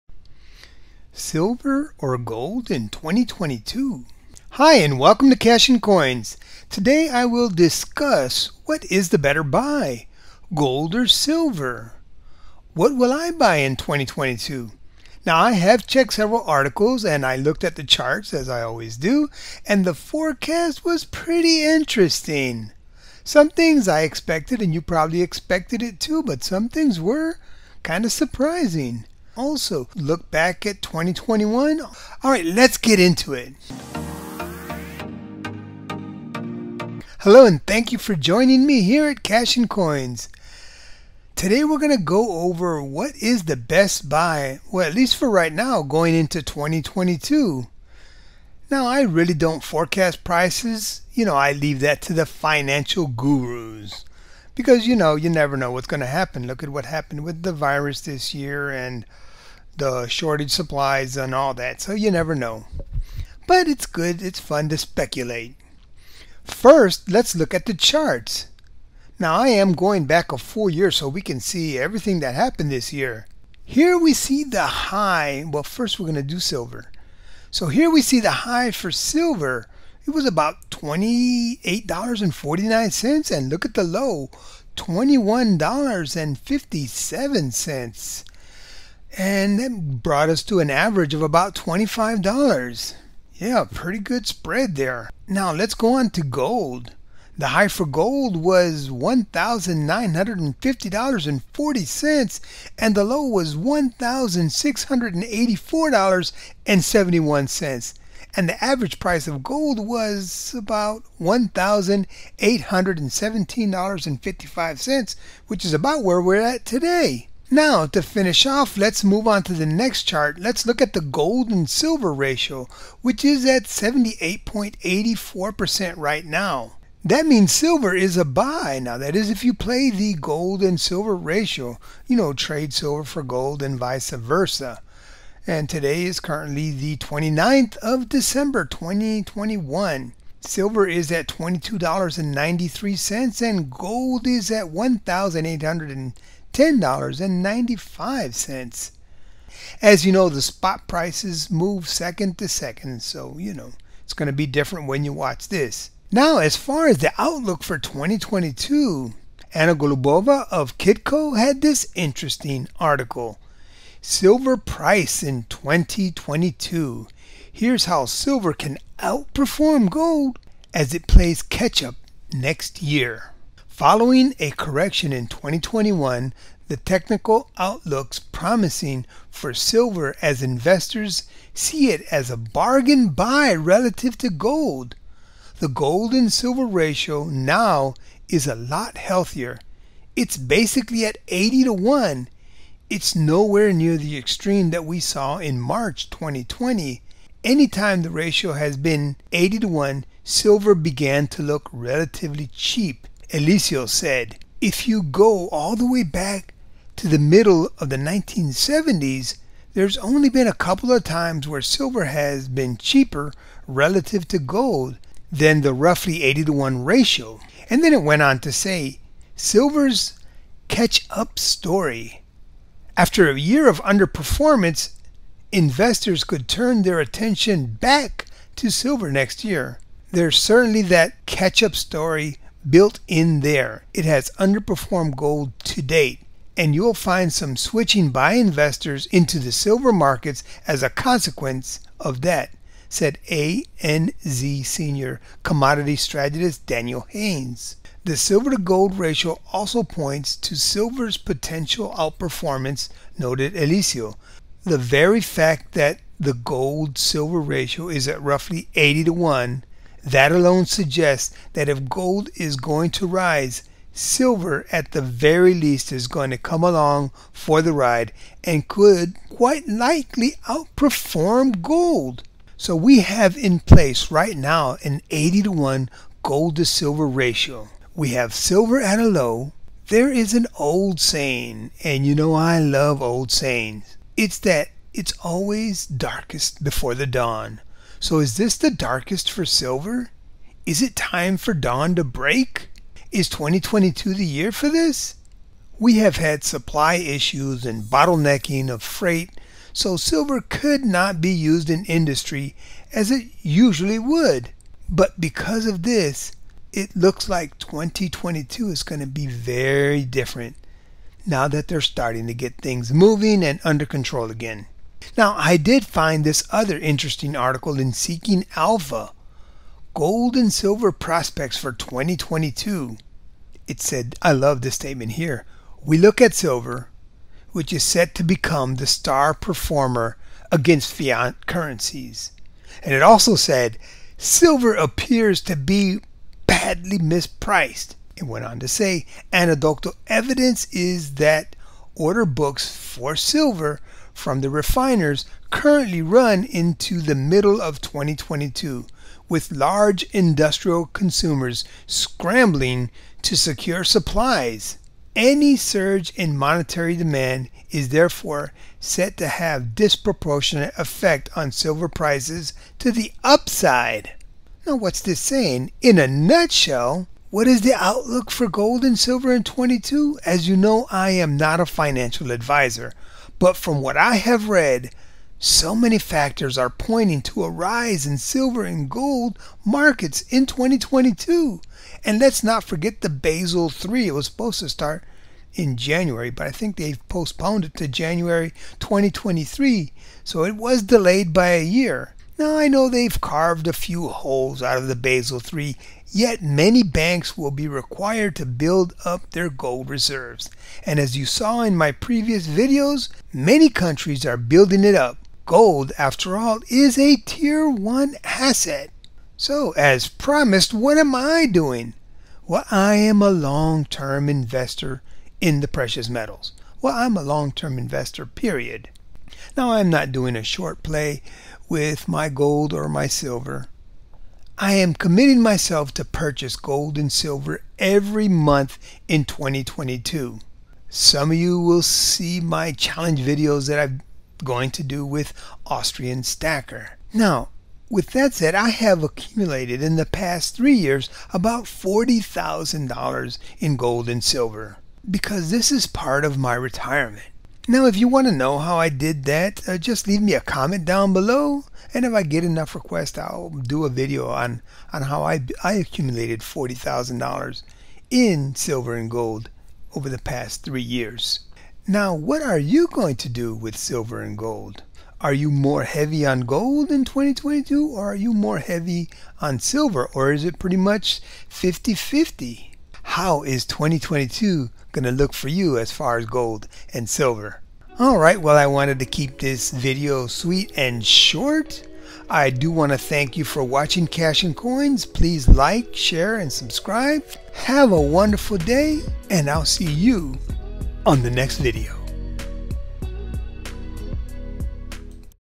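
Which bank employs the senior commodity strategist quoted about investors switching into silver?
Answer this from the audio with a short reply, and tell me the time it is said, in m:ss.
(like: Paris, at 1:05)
ANZ, at 4:03.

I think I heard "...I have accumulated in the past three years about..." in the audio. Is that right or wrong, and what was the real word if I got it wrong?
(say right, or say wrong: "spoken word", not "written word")
right.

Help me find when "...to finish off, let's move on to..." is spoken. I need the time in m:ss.
1:57.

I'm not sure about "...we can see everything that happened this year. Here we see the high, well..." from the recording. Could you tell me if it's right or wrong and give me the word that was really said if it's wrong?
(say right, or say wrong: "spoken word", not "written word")
right.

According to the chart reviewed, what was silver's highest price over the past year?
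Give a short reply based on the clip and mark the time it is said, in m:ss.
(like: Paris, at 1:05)
$28.49, at 1:20.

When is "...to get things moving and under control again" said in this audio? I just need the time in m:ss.
5:12.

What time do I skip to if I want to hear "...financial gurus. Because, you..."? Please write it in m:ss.
0:52.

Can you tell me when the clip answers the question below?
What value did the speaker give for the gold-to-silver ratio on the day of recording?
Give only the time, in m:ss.
2:03.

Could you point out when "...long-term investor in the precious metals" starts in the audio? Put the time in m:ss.
6:53.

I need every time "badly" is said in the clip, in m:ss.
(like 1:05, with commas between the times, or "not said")
5:36.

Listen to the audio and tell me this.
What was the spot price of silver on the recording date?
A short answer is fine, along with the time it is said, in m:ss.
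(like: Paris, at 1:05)
$22.93, at 2:21.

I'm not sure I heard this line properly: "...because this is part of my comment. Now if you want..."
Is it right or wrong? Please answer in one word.
wrong.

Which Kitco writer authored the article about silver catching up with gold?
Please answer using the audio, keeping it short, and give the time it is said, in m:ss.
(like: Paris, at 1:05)
Anna Golubova, at 2:39.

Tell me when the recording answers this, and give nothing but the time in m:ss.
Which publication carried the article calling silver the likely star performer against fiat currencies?
5:17.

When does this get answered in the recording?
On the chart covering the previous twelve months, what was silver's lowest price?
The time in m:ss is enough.
1:24.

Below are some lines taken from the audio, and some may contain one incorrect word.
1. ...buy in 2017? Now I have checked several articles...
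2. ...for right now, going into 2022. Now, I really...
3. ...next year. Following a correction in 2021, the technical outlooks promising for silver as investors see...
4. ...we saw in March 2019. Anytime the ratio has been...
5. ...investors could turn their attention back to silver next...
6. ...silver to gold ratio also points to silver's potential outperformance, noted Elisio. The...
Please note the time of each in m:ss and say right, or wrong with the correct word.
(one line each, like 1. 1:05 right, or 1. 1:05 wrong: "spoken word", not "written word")
1. 0:13 wrong: "2022", not "2017"
2. 0:45 right
3. 2:52 right
4. 3:14 wrong: "2020", not "2019"
5. 3:45 right
6. 4:08 right.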